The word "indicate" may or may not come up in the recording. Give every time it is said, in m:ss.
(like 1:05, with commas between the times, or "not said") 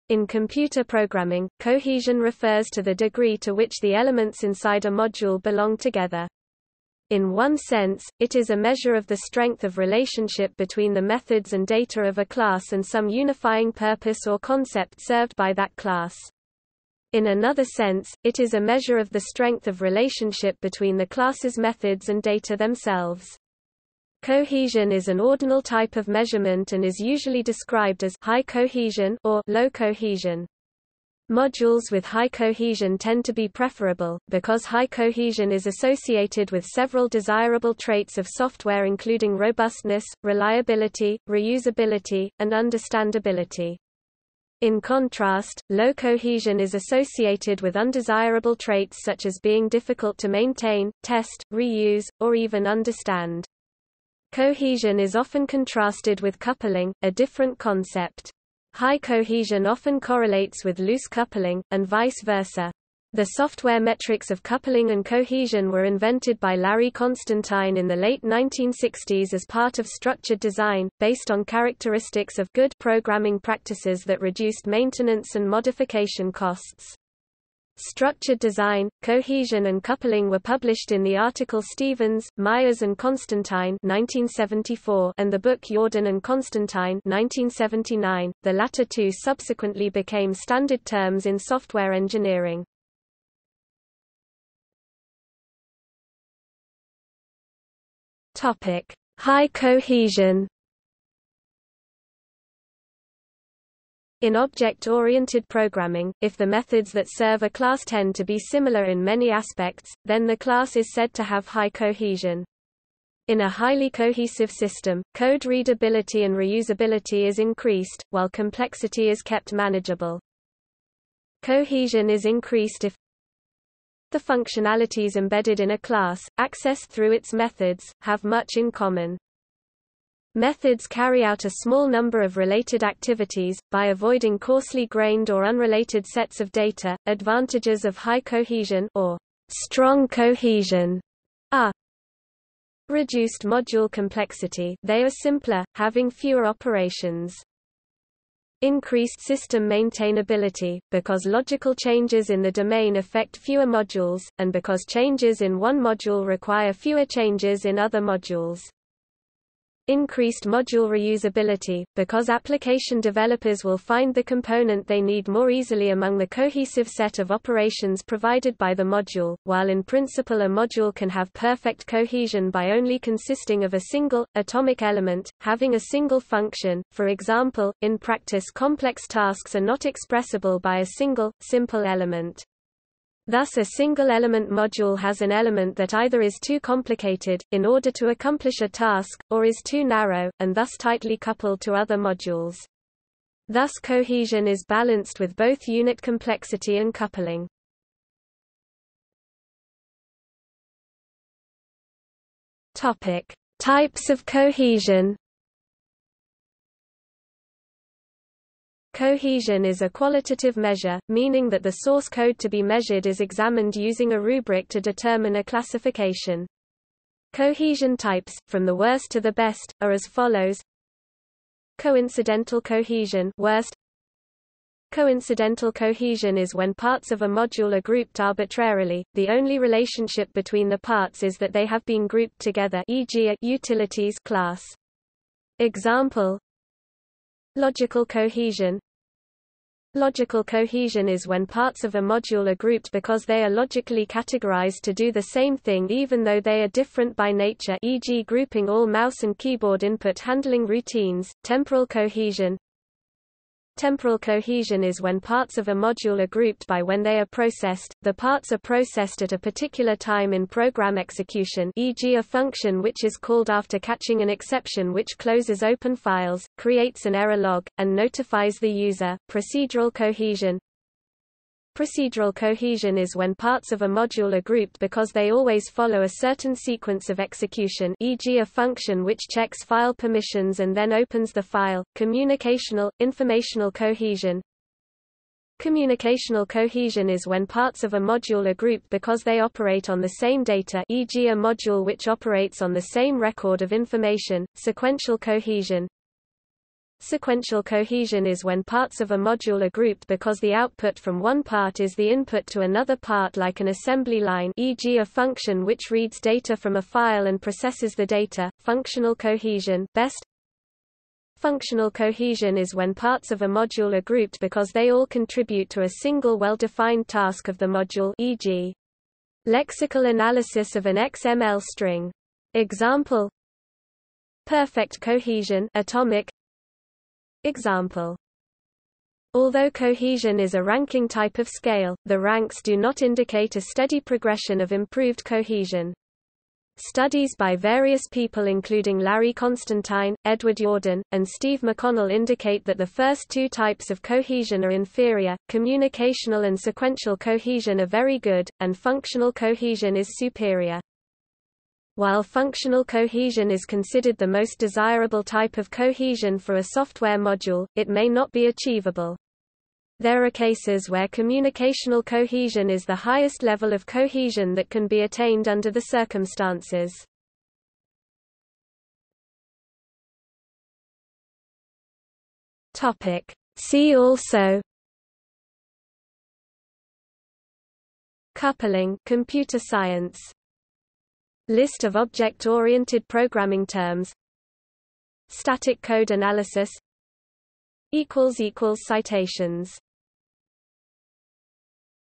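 5:33, 5:42.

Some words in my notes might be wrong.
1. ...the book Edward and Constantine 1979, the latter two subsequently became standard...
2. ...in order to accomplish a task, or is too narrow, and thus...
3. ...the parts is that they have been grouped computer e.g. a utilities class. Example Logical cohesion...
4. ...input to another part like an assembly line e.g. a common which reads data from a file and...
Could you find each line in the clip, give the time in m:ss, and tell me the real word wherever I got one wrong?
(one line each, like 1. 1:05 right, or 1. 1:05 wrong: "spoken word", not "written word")
1. 1:25 wrong: "Yourdon", not "Edward"
2. 3:07 right
3. 3:50 wrong: "together", not "computer"
4. 5:02 wrong: "function", not "common".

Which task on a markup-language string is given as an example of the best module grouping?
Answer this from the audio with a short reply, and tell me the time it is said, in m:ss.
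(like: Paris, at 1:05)
lexical analysis, at 5:19.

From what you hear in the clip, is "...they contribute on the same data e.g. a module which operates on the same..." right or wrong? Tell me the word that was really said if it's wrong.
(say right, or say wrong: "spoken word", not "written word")
wrong: "operate", not "contribute".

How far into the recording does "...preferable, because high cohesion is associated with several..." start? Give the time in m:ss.
0:33.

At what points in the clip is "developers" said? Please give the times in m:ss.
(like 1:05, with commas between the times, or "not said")
2:43.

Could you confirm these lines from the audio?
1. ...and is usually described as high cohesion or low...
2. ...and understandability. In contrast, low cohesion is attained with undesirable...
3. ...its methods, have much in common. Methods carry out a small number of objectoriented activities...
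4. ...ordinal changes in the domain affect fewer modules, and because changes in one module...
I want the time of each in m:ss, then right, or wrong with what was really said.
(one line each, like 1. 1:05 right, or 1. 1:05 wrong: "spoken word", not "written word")
1. 0:26 right
2. 0:42 wrong: "associated", not "attained"
3. 2:07 wrong: "related", not "objectoriented"
4. 2:31 wrong: "logical", not "ordinal".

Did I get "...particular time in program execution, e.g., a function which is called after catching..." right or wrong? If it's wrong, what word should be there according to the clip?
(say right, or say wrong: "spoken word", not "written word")
right.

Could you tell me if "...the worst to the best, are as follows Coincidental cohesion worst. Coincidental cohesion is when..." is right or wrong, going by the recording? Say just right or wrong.
right.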